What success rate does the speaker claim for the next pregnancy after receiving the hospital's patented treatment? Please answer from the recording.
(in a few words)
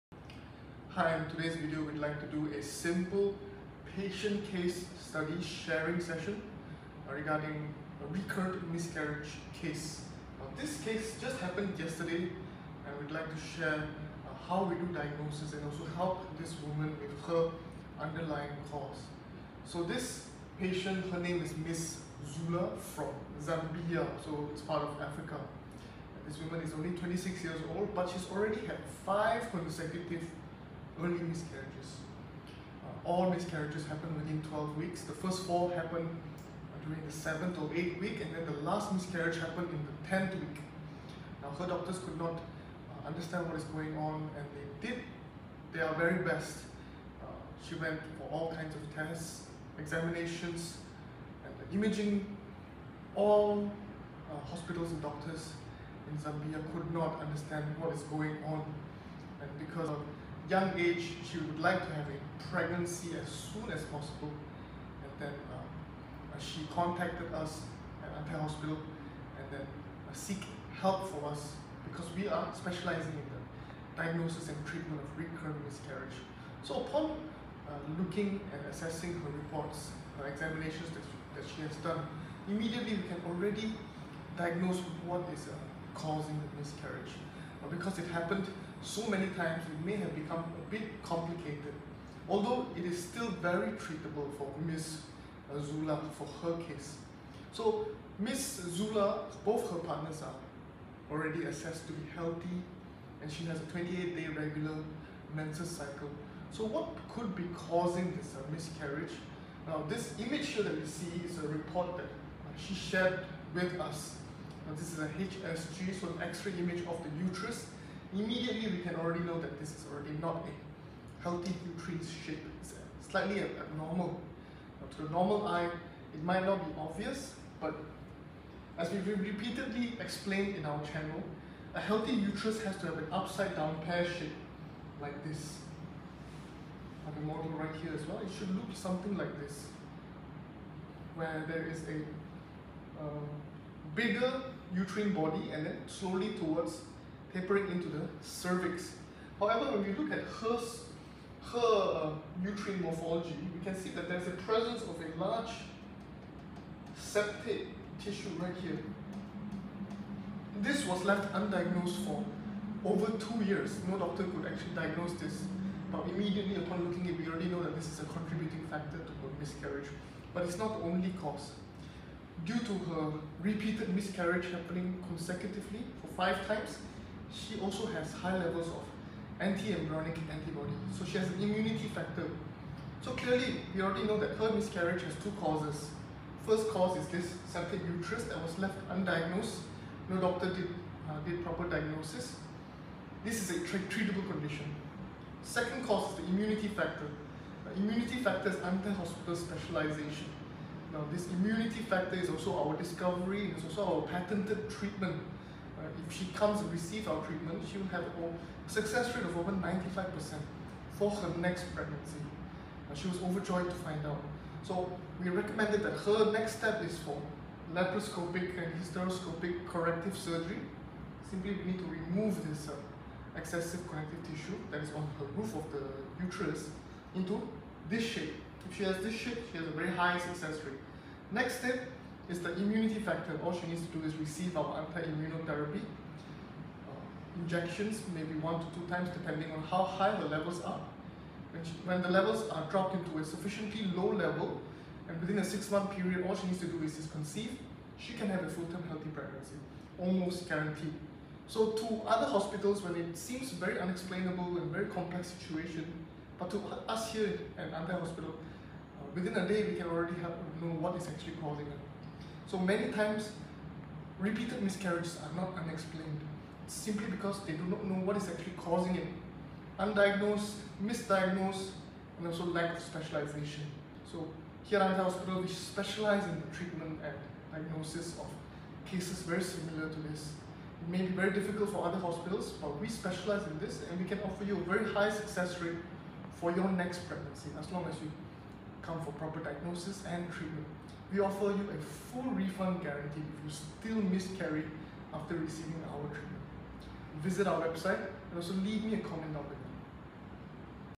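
over 95%.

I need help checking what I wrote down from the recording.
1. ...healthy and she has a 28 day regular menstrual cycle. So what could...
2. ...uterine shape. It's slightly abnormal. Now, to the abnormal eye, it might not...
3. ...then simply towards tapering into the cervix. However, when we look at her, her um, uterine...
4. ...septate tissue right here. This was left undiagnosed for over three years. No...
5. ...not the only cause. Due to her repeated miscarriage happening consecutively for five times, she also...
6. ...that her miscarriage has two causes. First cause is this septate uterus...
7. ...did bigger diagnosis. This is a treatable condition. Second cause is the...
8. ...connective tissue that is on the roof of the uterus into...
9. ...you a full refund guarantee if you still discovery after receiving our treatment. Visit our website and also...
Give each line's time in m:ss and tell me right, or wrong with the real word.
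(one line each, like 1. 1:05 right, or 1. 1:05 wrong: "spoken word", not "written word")
1. 1:42 right
2. 2:01 wrong: "normal", not "abnormal"
3. 2:25 wrong: "slowly", not "simply"
4. 2:36 wrong: "two", not "three"
5. 2:50 right
6. 3:04 right
7. 3:11 wrong: "proper", not "bigger"
8. 3:43 right
9. 4:51 wrong: "miscarry", not "discovery".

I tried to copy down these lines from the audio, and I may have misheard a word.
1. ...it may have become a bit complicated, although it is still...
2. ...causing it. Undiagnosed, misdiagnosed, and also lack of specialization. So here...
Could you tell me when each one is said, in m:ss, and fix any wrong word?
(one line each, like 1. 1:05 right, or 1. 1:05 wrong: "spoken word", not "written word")
1. 1:29 right
2. 4:28 right.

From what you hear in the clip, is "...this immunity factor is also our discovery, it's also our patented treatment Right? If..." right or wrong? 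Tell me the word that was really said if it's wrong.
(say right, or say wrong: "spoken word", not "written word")
right.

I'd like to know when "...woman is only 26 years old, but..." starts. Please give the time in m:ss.
0:26.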